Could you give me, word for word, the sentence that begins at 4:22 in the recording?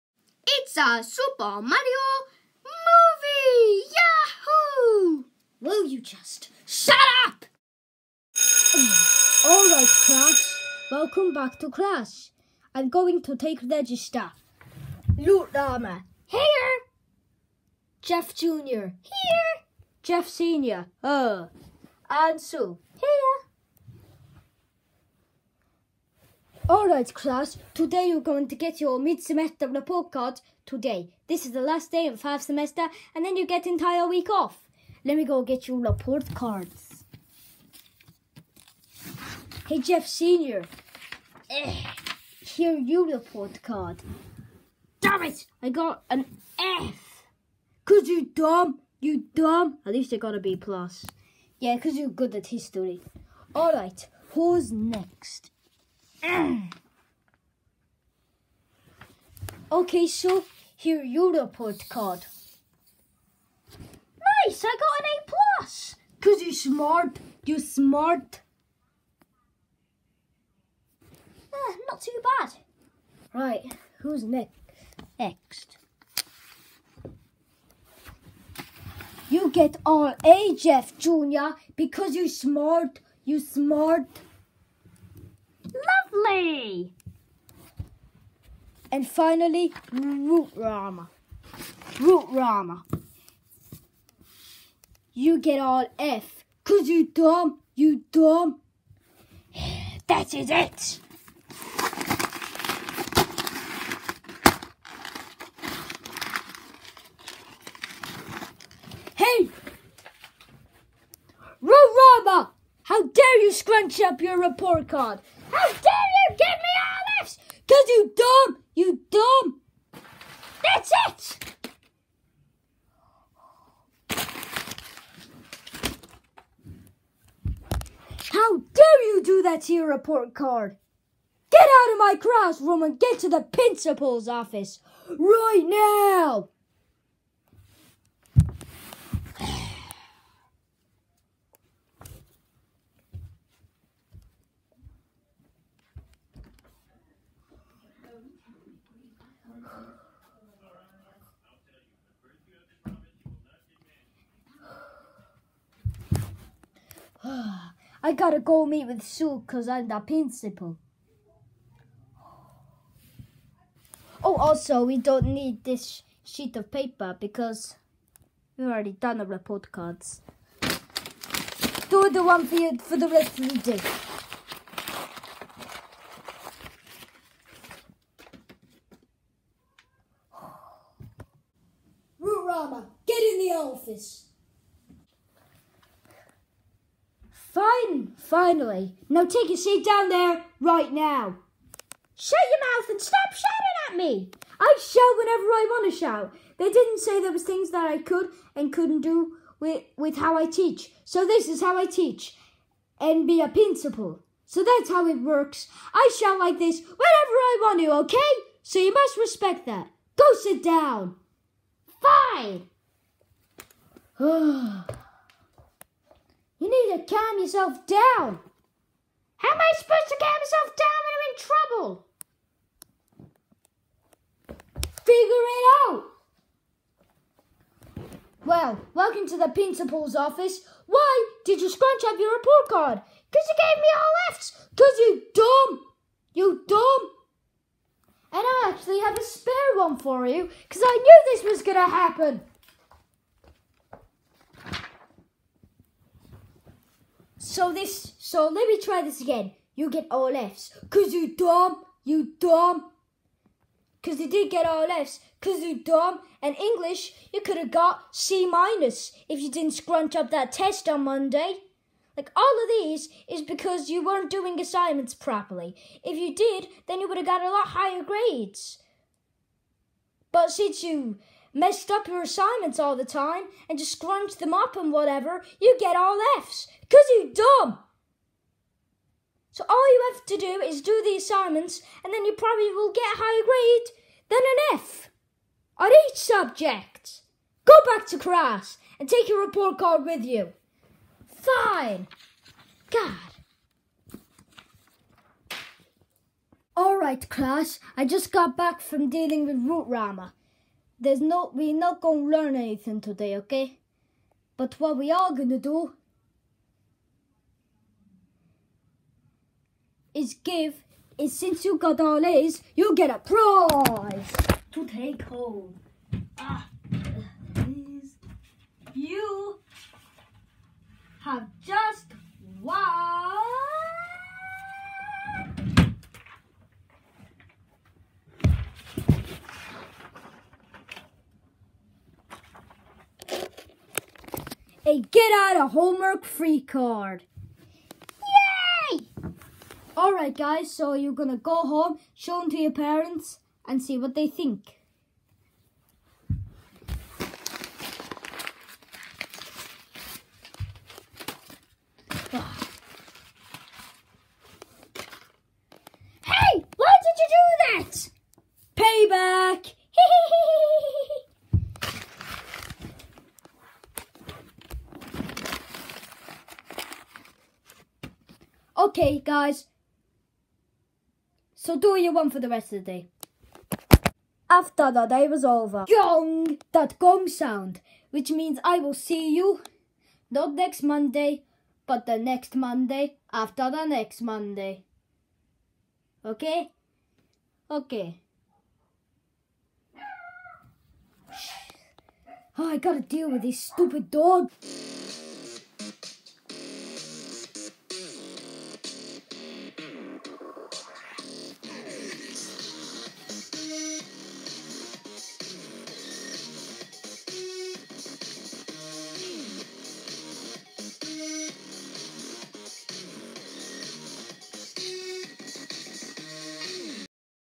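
Like all of these is because you weren't doing assignments properly.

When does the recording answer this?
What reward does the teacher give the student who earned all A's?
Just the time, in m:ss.
5:35.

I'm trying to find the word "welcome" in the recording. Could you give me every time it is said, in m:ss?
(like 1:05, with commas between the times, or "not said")
0:10, 3:48.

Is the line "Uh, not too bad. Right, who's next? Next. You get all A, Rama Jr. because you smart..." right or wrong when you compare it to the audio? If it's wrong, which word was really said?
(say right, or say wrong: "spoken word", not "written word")
wrong: "Jeff", not "Rama".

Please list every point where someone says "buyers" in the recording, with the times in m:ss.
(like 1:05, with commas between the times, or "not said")
not said.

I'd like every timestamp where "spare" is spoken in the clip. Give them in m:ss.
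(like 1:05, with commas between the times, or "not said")
3:59.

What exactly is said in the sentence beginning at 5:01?
There's no, we're not gonna learn anything today, okay?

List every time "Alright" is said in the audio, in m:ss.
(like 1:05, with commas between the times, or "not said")
0:09, 0:26, 0:53, 4:56, 5:39.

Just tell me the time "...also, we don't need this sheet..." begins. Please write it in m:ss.
2:44.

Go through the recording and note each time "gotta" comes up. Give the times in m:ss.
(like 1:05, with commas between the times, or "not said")
2:38, 6:32.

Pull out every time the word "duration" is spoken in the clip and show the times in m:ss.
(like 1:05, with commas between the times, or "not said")
not said.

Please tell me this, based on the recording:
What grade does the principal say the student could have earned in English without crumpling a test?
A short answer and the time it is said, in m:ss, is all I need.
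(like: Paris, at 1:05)
C minus, at 4:18.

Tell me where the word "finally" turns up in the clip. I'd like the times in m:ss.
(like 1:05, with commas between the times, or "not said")
1:29, 3:08.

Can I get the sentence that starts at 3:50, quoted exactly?
Why did you scrunch up your report card?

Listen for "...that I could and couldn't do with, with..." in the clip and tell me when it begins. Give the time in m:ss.
3:17.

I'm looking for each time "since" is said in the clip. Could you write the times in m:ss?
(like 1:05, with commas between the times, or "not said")
4:30, 5:11.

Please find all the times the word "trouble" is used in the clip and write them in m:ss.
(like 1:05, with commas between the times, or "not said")
3:41.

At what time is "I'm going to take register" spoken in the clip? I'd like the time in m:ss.
0:12.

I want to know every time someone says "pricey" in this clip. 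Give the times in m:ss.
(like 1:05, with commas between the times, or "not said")
not said.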